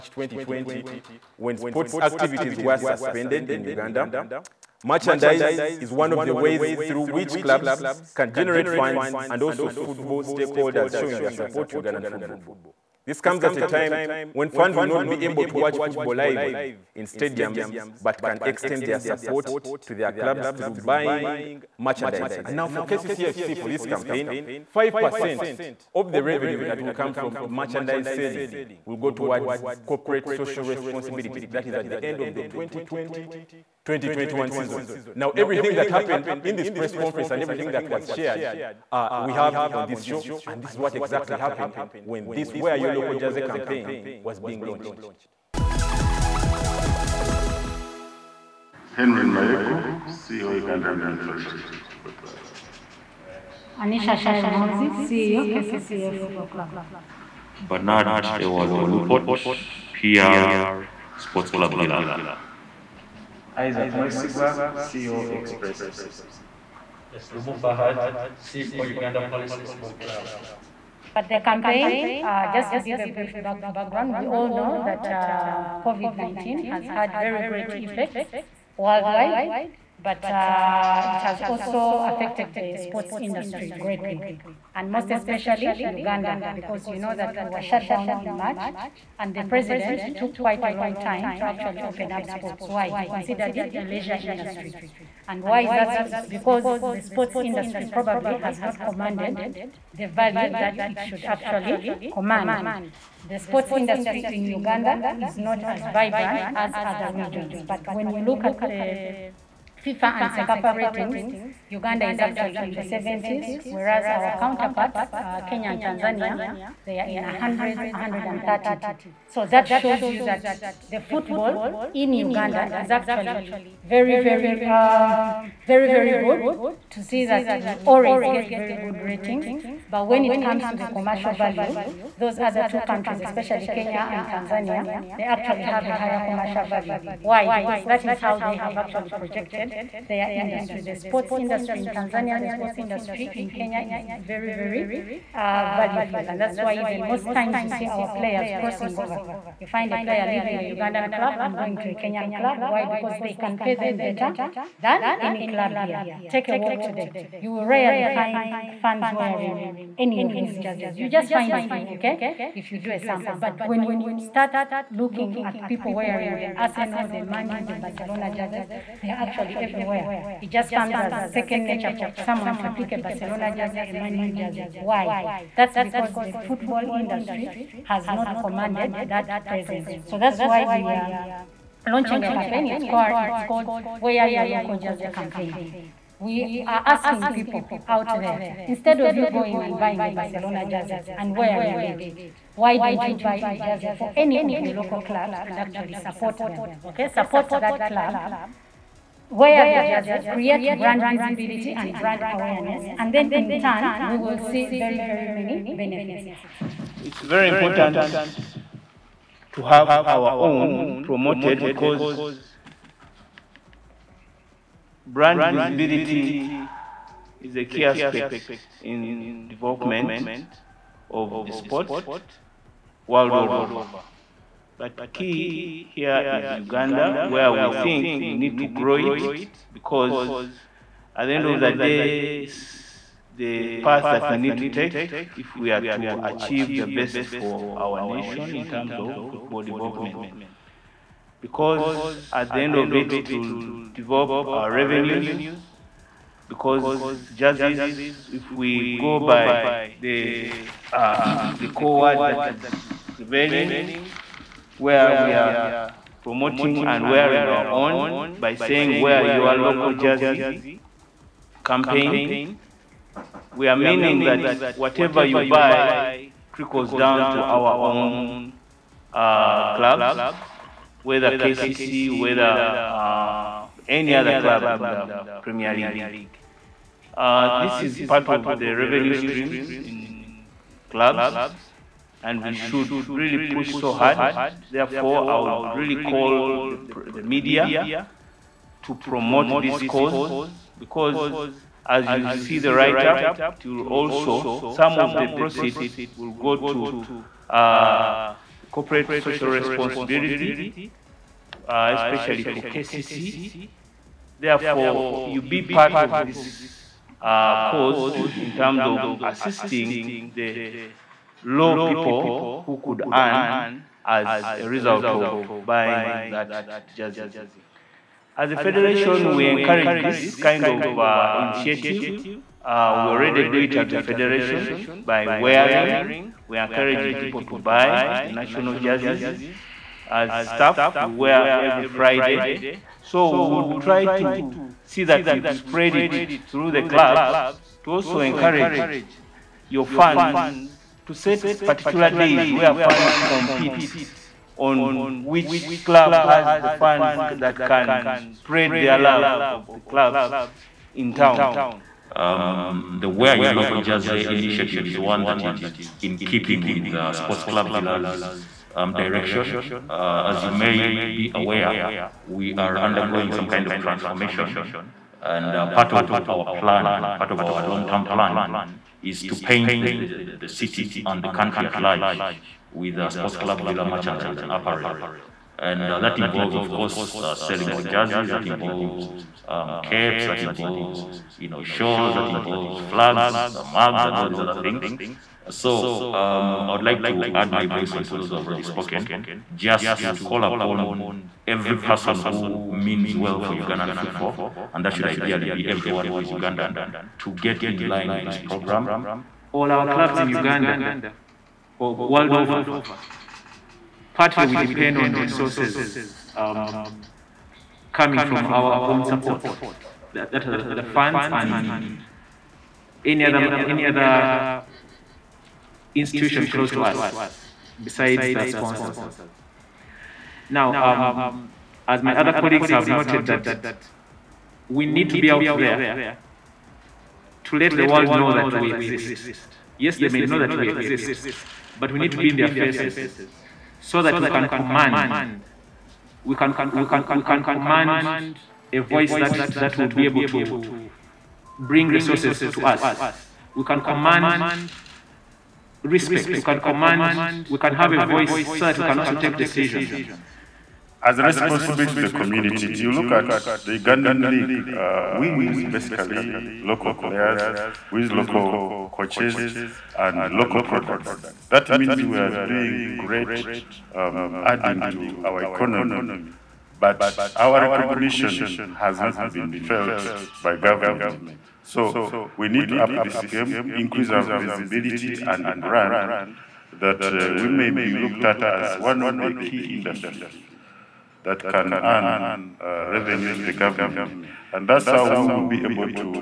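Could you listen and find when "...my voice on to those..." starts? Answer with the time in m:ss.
6:27.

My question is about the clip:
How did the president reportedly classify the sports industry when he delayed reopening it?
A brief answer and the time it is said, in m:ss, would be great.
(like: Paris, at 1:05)
a leisure industry, at 1:33.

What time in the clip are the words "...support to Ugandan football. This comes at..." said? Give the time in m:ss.
0:11.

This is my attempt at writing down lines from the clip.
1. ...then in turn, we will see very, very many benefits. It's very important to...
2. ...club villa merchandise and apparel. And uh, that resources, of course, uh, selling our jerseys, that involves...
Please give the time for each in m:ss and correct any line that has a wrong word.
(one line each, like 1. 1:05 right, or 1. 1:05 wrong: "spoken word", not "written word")
1. 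3:23 right
2. 6:13 wrong: "involves", not "resources".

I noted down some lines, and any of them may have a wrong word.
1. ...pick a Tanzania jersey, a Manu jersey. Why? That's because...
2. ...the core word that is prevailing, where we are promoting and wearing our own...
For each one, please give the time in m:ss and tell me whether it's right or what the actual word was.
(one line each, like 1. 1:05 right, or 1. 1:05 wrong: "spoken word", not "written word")
1. 2:52 wrong: "Barcelona", not "Tanzania"
2. 4:11 right.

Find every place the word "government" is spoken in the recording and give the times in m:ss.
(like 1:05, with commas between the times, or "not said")
7:50, 8:03.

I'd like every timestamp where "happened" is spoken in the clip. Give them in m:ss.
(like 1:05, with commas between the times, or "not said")
0:35, 0:41.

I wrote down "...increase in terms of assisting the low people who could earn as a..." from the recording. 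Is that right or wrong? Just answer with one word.
wrong.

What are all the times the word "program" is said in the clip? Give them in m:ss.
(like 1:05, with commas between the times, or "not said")
6:38.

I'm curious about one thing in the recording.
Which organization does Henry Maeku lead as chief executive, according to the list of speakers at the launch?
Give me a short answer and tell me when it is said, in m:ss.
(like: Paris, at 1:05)
Uganda Revenue Authority, at 0:50.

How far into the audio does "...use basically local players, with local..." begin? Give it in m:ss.
7:35.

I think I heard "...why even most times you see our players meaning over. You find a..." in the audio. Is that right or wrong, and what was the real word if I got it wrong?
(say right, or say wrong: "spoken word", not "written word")
wrong: "crossing", not "meaning".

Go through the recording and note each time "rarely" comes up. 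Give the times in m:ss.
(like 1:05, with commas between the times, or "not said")
2:37.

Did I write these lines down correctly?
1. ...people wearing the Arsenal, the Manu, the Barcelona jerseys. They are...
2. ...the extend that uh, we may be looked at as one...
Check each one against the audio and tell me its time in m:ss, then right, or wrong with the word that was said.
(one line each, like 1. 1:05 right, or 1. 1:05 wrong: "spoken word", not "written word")
1. 2:45 right
2. 7:55 wrong: "brand", not "extend".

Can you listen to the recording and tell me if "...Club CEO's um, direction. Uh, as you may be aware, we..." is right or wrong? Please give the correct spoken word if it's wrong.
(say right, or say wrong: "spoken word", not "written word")
wrong: "Villa", not "CEO".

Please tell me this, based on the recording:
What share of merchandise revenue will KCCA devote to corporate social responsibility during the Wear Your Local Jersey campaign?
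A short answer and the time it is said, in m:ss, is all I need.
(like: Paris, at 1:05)
5%, at 0:24.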